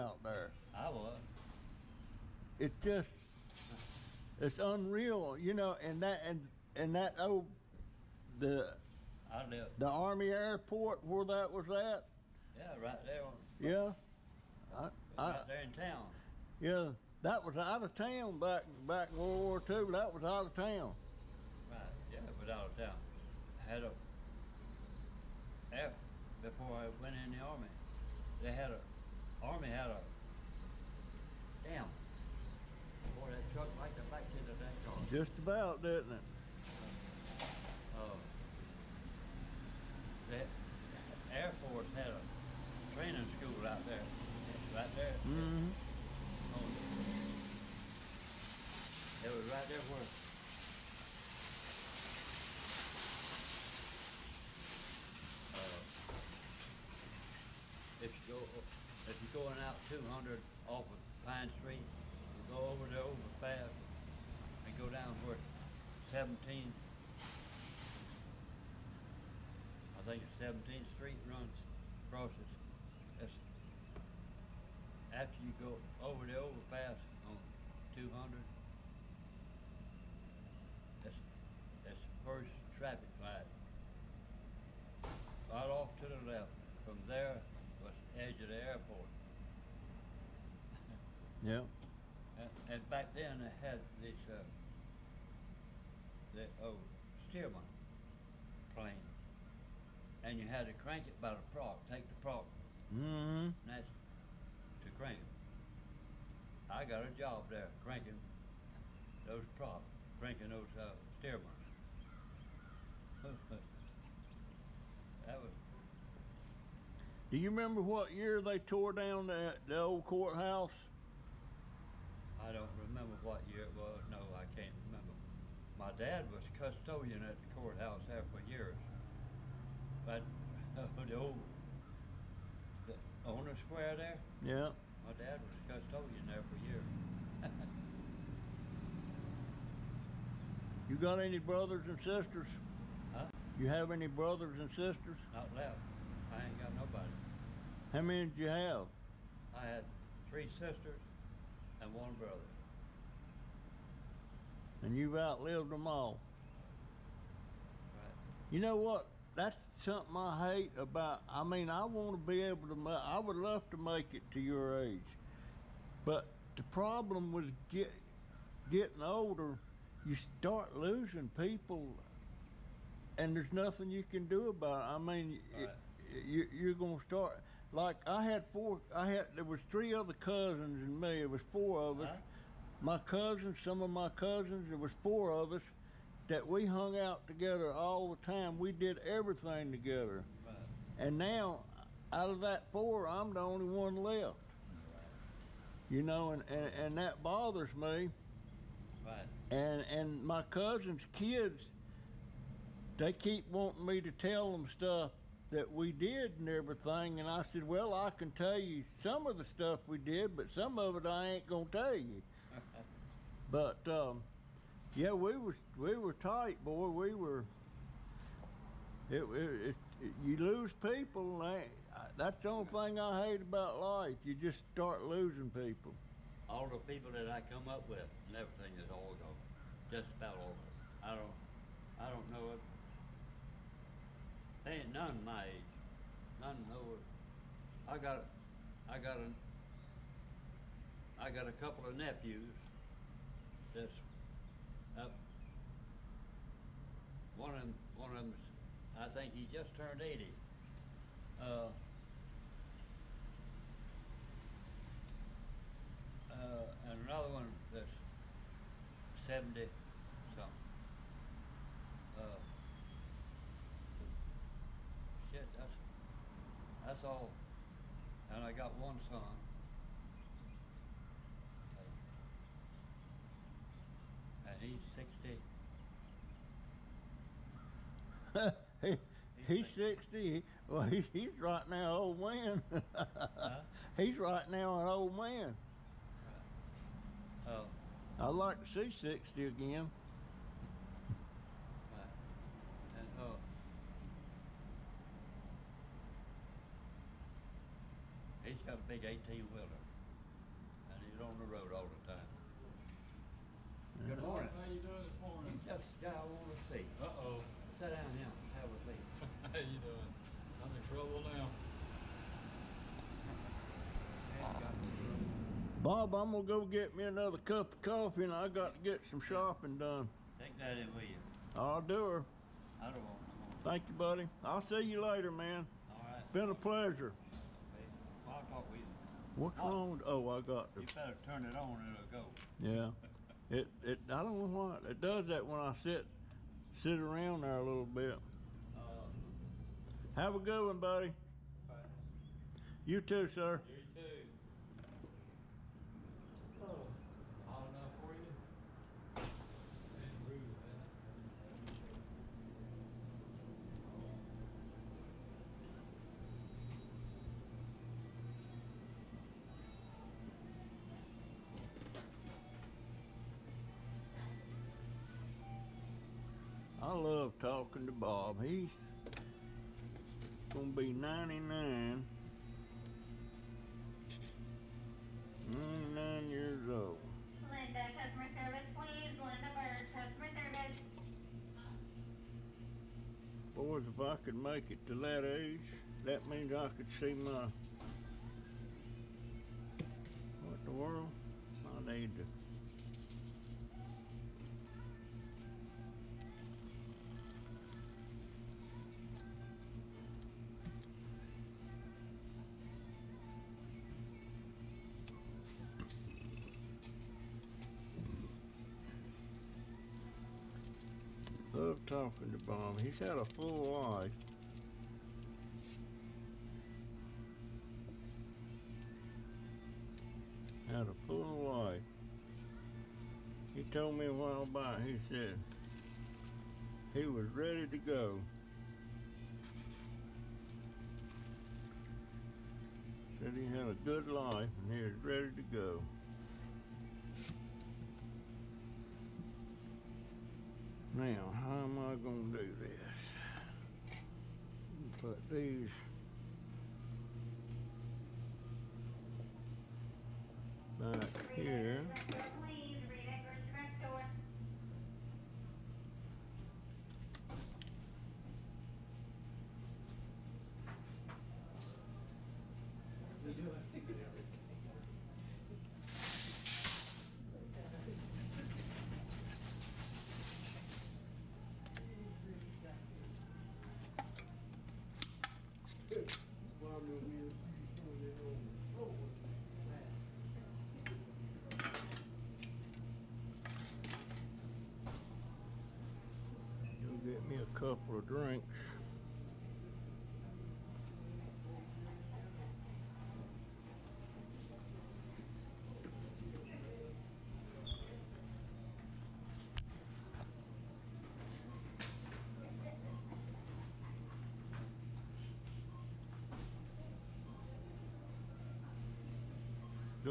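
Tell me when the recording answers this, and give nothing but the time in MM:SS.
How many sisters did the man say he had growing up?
02:30.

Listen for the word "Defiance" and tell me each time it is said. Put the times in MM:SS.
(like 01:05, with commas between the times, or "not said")
not said.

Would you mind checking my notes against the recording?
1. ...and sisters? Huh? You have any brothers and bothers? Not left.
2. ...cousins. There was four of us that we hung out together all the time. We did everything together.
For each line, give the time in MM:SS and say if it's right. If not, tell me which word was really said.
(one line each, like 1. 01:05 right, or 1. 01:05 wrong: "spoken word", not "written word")
1. 02:21 wrong: "sisters", not "bothers"
2. 03:04 right.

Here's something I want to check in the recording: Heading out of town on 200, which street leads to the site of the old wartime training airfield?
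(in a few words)
Pine Street.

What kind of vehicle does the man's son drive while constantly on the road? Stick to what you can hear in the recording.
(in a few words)
18-wheeler.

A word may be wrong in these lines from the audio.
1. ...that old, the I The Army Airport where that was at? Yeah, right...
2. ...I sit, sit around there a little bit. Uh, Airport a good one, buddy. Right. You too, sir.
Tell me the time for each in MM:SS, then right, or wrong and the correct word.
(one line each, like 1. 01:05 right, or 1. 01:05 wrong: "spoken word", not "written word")
1. 00:06 right
2. 05:35 wrong: "Have", not "Airport".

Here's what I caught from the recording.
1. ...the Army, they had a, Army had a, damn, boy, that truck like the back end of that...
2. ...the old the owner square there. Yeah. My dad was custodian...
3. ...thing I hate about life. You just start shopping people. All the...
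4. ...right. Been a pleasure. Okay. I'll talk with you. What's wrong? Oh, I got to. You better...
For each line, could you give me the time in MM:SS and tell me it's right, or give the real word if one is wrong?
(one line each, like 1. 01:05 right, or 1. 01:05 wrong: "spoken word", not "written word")
1. 00:27 right
2. 02:11 right
3. 03:42 wrong: "losing", not "shopping"
4. 05:25 right.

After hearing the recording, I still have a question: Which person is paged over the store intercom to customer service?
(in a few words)
Linda Bird.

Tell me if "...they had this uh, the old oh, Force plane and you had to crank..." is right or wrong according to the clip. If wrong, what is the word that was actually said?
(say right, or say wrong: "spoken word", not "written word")
wrong: "Stearman", not "Force".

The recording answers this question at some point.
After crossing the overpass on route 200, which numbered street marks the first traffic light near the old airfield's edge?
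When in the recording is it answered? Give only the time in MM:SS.
01:10.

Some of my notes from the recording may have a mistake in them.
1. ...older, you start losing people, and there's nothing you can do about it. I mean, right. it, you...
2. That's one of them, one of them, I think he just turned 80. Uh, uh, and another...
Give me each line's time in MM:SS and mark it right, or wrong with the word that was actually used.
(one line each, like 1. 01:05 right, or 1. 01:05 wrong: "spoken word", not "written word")
1. 02:48 right
2. 04:03 right.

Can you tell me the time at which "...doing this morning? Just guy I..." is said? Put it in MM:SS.
05:04.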